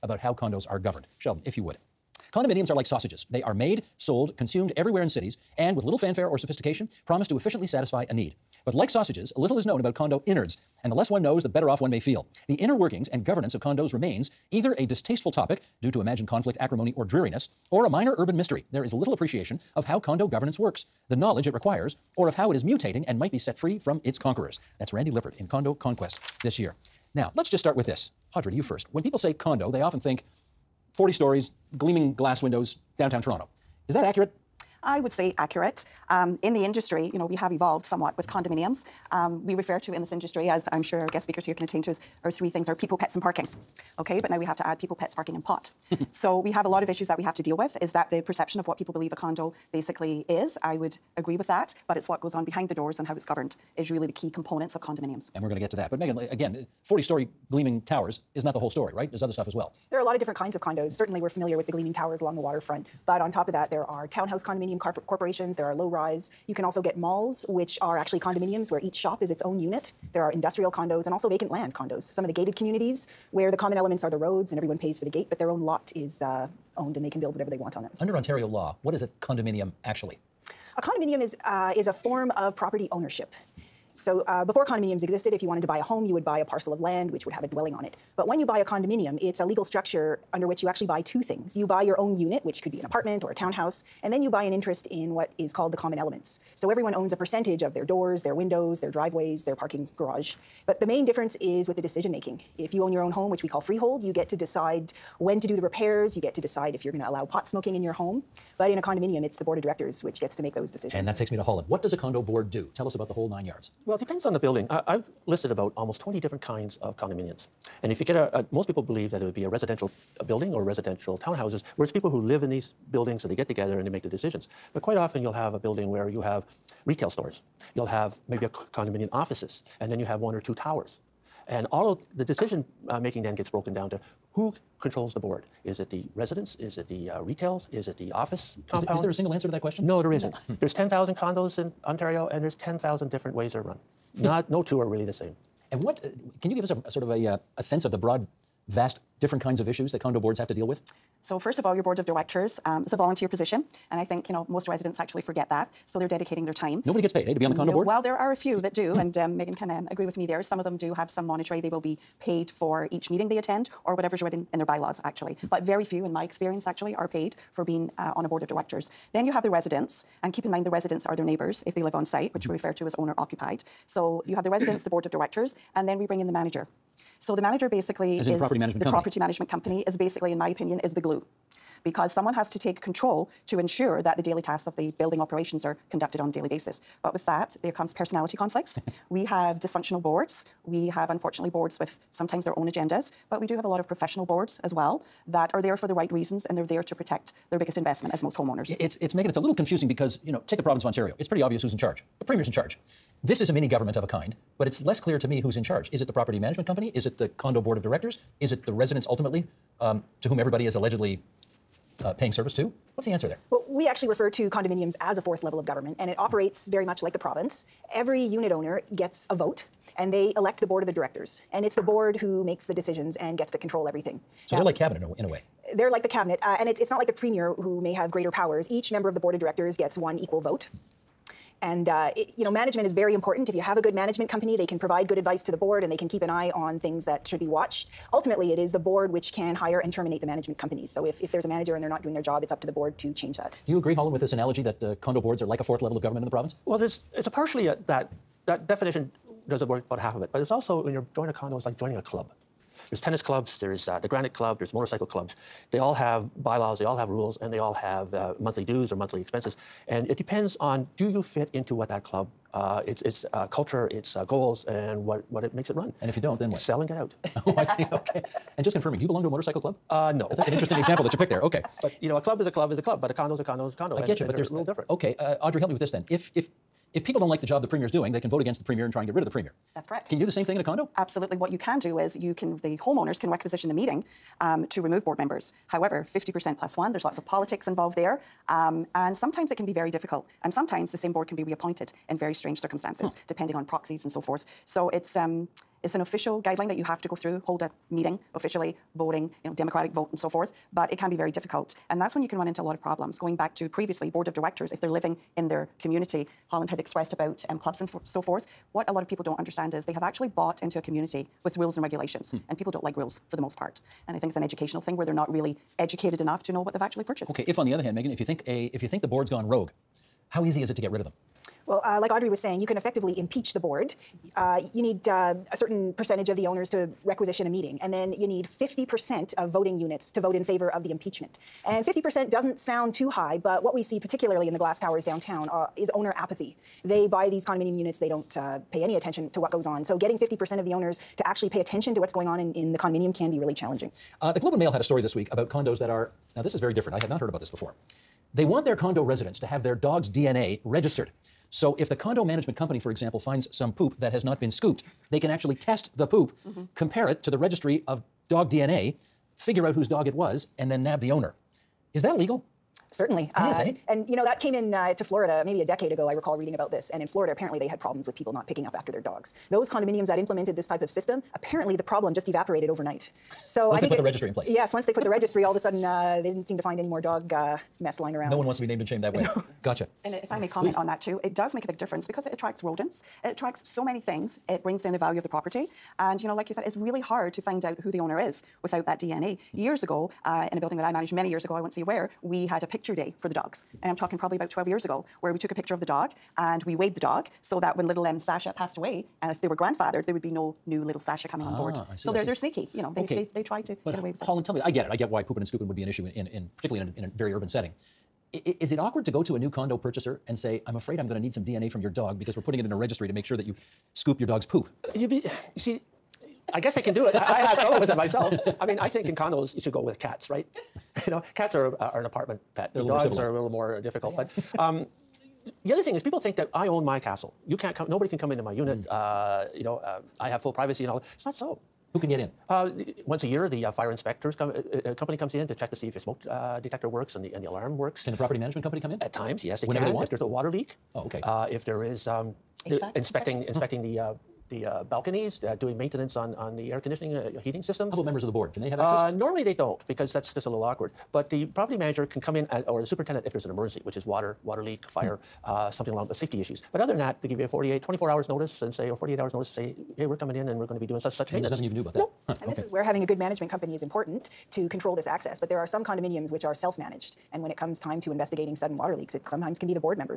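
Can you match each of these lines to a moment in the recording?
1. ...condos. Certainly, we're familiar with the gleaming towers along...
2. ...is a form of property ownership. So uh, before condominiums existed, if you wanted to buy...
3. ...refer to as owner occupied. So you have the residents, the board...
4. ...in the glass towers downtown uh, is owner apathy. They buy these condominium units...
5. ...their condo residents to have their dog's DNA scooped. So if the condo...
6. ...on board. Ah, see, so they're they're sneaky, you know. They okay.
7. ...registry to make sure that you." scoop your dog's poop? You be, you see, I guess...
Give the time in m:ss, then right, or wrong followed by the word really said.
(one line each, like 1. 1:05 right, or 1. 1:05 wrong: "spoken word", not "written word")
1. 1:00 right
2. 1:21 right
3. 2:52 right
4. 5:34 right
5. 5:48 wrong: "registered", not "scooped"
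6. 6:41 right
7. 6:52 right.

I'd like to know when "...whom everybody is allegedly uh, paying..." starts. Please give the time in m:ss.
3:30.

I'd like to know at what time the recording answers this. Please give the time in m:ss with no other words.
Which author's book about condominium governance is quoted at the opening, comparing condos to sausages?
0:24.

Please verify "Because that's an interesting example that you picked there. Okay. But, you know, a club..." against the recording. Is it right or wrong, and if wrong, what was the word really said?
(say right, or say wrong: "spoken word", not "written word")
right.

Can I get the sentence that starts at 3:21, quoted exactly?
It's pretty obvious who's in charge.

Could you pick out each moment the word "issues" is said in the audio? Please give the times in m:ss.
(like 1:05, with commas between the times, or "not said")
0:46, 2:29, 6:45, 7:36.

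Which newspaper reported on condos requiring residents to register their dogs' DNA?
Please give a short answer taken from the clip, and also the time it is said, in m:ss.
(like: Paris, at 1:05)
The Globe and Mail, at 5:44.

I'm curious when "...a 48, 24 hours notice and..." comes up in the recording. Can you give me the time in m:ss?
7:37.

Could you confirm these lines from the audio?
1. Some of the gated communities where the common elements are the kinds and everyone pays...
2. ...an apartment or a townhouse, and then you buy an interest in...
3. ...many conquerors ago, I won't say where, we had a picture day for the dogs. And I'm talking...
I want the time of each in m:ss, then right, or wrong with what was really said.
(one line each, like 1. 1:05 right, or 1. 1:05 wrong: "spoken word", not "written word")
1. 1:12 wrong: "roads", not "kinds"
2. 1:32 right
3. 6:31 wrong: "years", not "conquerors".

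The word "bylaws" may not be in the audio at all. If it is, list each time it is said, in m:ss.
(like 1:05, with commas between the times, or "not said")
2:44, 4:16.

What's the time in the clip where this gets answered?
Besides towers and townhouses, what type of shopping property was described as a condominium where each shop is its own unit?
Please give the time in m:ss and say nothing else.
1:06.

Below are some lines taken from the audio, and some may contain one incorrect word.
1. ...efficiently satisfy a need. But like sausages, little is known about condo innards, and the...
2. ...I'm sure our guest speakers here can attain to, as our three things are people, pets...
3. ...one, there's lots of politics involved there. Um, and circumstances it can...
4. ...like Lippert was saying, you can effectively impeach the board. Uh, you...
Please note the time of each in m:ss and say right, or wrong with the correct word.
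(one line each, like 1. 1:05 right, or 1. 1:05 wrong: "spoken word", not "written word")
1. 0:07 right
2. 0:40 right
3. 4:46 wrong: "sometimes", not "circumstances"
4. 5:21 wrong: "Audrey", not "Lippert".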